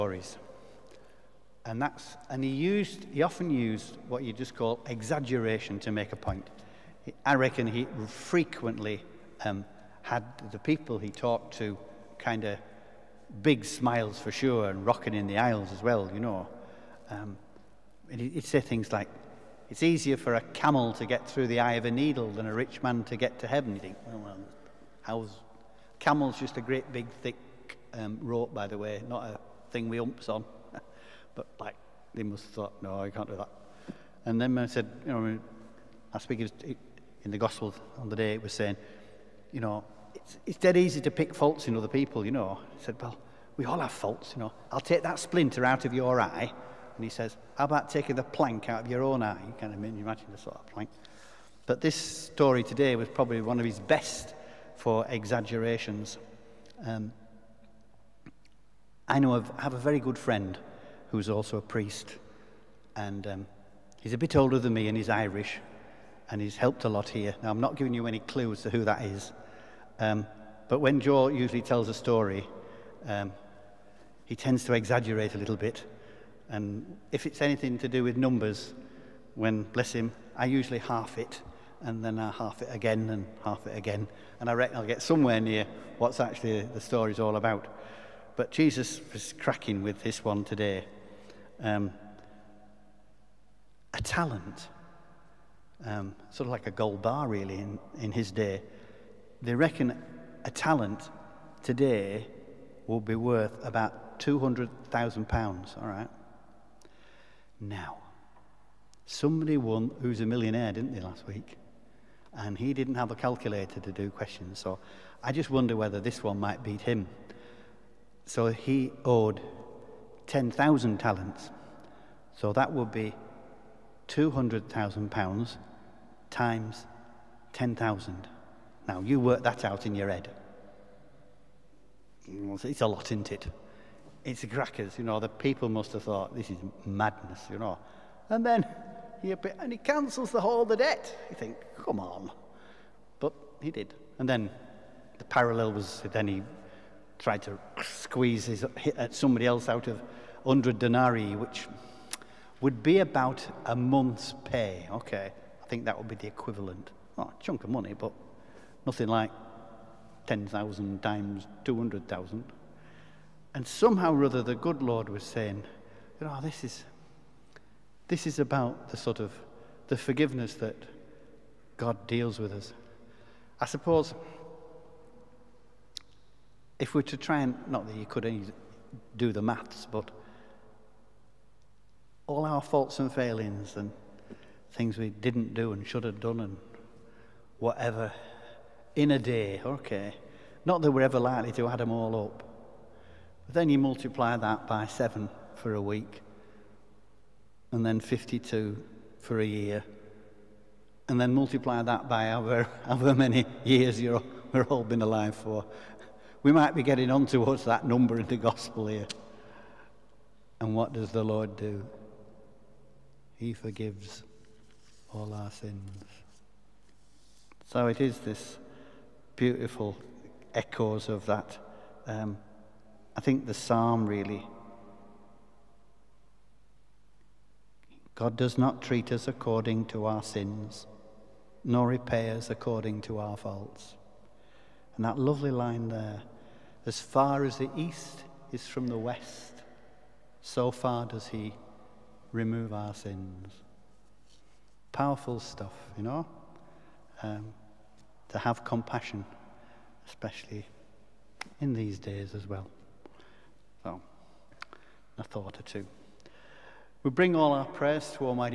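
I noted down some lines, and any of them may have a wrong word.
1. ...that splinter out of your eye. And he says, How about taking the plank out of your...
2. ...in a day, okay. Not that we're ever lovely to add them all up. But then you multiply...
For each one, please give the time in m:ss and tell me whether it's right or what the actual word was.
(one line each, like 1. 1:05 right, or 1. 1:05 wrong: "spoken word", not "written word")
1. 0:45 right
2. 3:08 wrong: "likely", not "lovely".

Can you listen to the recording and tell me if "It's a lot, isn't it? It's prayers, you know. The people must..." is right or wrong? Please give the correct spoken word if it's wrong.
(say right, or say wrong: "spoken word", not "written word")
wrong: "crackers", not "prayers".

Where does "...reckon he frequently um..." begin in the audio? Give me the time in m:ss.
0:07.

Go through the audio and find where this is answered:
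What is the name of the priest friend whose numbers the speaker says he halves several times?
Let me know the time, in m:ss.
1:10.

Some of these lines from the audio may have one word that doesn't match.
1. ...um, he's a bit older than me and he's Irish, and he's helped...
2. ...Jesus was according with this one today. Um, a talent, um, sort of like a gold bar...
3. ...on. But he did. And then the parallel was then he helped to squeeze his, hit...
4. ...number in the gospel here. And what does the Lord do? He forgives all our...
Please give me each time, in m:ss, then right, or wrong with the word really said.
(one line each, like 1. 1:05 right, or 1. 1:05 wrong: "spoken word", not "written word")
1. 1:03 right
2. 1:28 wrong: "cracking", not "according"
3. 2:21 wrong: "tried", not "helped"
4. 3:27 right.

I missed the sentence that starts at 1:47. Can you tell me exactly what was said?
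Now, somebody won who's a millionaire, didn't they, last week?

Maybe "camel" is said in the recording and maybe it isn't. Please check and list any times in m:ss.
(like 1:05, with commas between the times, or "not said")
0:20, 0:25.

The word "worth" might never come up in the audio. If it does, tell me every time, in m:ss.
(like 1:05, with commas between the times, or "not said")
1:43.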